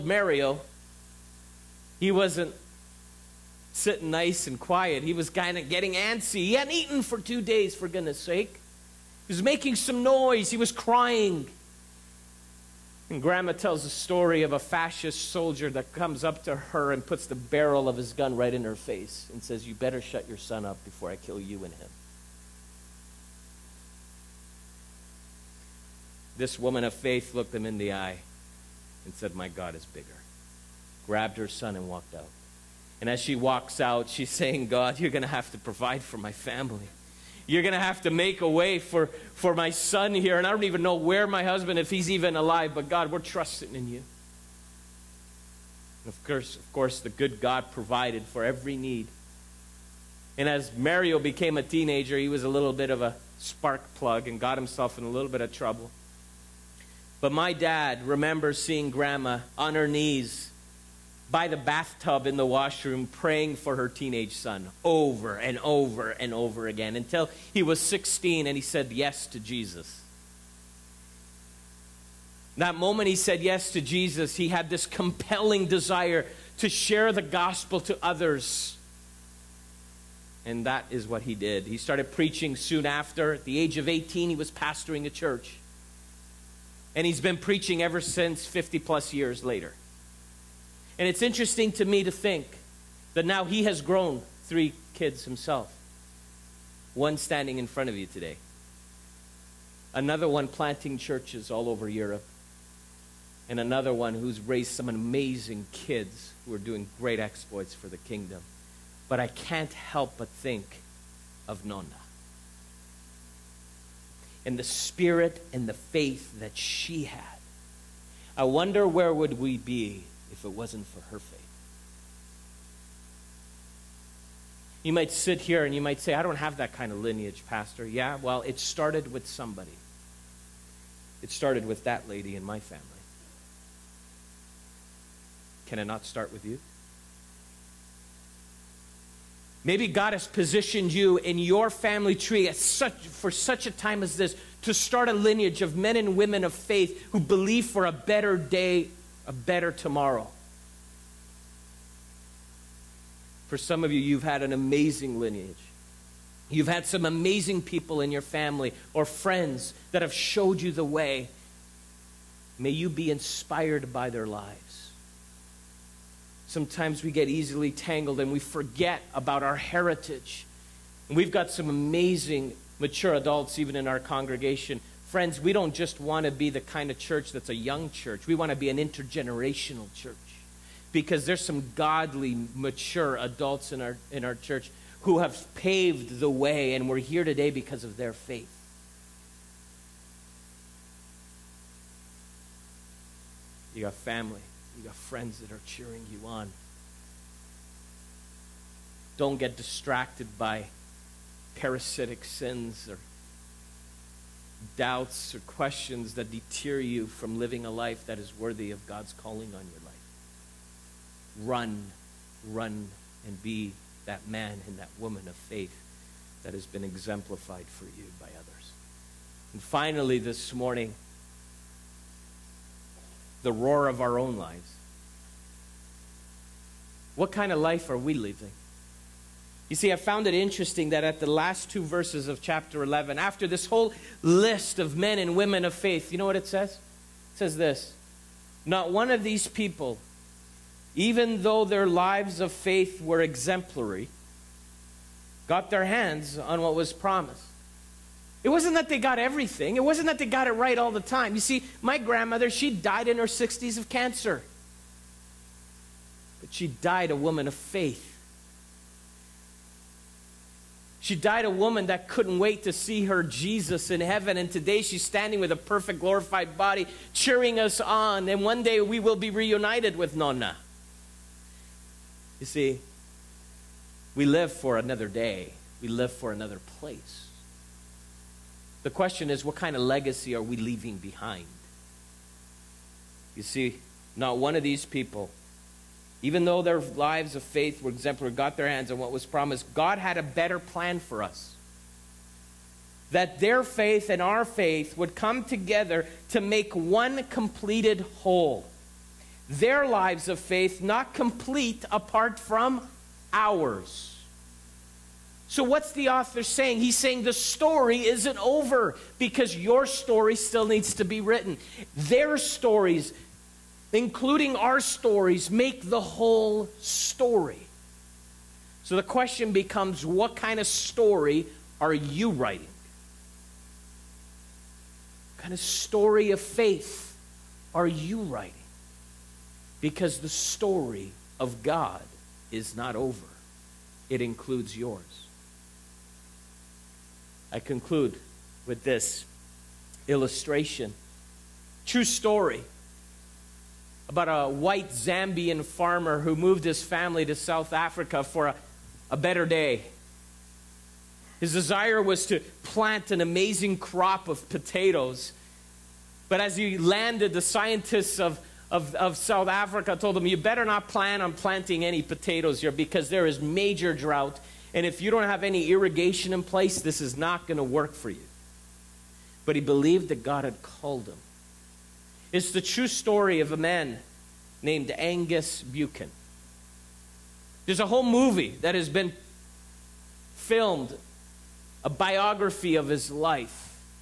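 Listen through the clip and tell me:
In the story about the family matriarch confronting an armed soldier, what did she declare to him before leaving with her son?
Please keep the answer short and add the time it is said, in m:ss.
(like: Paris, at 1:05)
My God is bigger, at 0:29.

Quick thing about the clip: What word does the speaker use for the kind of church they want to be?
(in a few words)
intergenerational.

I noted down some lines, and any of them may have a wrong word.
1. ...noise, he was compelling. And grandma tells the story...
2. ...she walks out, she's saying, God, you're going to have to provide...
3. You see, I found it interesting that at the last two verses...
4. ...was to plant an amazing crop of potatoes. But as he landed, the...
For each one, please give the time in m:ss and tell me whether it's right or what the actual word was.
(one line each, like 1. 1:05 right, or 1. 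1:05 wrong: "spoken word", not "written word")
1. 0:10 wrong: "crying", not "compelling"
2. 0:33 right
3. 3:49 right
4. 5:52 right.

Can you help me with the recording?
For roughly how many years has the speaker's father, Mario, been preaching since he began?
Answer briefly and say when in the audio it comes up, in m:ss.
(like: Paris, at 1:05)
50 plus years, at 1:28.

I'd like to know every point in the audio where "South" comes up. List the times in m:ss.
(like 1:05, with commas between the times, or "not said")
5:47, 5:59.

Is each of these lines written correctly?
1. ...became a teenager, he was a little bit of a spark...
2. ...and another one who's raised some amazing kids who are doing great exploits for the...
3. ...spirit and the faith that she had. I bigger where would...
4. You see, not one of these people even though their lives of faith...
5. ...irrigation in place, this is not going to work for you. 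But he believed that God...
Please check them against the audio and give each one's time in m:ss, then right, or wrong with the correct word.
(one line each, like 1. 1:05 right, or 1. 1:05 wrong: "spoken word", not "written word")
1. 0:51 right
2. 1:43 right
3. 1:54 wrong: "wonder", not "bigger"
4. 4:43 right
5. 6:05 right.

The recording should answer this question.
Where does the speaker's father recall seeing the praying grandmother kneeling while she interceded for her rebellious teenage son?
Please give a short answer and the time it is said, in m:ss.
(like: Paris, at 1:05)
by the bathtub, at 1:01.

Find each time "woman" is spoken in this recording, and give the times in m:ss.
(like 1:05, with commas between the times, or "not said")
0:26, 3:34, 4:17, 4:21.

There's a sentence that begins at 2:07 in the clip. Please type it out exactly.
Yeah, well, it started with somebody.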